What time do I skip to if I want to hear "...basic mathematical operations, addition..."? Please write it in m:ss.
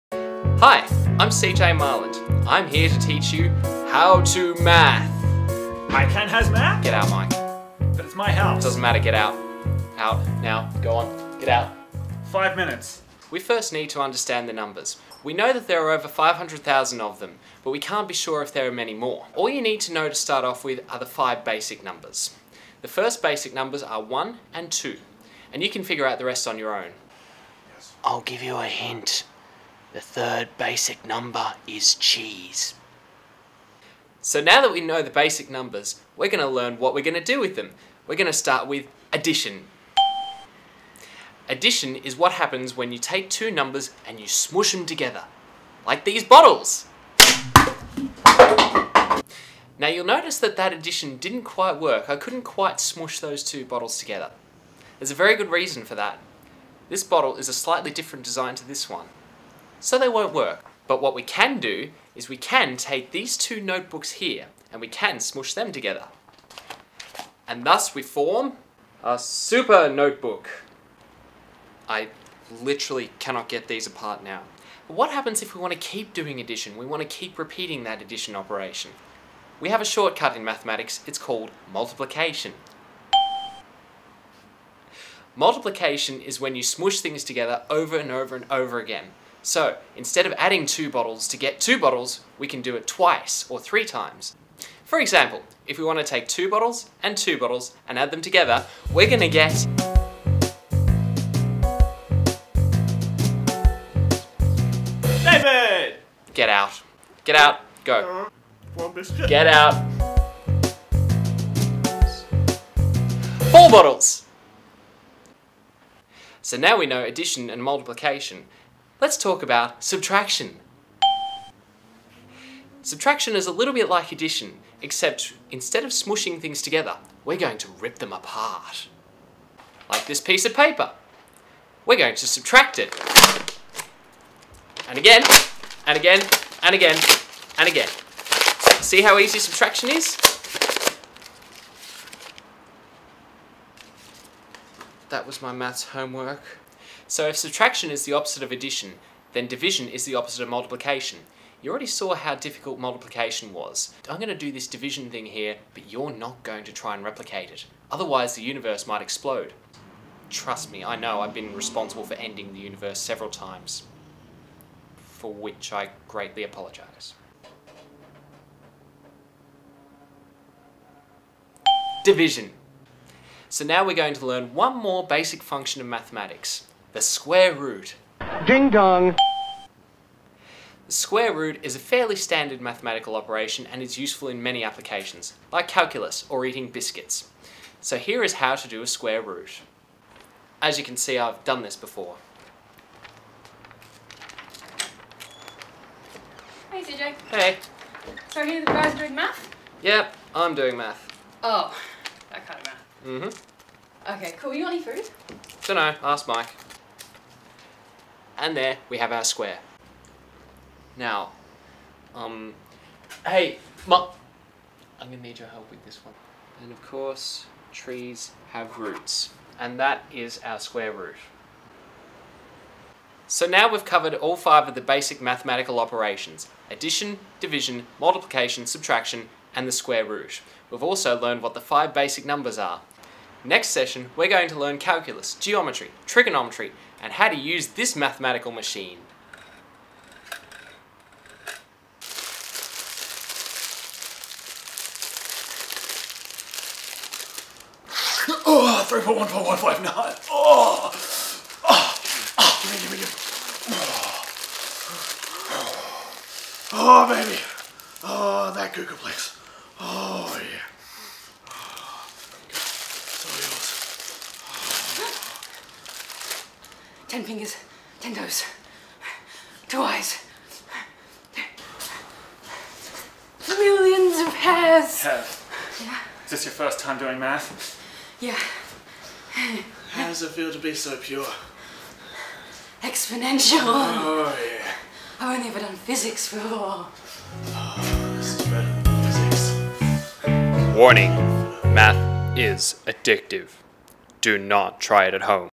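3:44.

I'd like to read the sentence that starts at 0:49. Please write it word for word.
Now you'll notice that that addition didn't quite work.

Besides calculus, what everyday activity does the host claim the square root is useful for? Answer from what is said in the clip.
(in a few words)
Eating biscuits.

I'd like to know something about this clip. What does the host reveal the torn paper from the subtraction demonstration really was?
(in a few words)
My maths homework.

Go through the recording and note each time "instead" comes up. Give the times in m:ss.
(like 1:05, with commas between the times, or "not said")
1:29, 2:05.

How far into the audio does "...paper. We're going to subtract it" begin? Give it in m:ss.
2:10.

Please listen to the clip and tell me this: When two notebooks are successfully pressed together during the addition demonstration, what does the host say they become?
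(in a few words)
A super notebook.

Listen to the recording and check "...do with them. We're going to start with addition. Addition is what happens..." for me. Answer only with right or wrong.
right.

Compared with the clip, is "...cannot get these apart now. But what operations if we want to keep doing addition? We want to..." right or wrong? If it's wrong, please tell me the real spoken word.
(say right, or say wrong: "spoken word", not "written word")
wrong: "happens", not "operations".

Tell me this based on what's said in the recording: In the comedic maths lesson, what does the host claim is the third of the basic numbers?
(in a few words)
Cheese.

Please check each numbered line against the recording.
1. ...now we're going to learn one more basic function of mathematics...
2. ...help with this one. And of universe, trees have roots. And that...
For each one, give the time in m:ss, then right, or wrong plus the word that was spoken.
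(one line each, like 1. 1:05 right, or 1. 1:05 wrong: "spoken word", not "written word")
1. 2:53 right
2. 3:35 wrong: "course", not "universe".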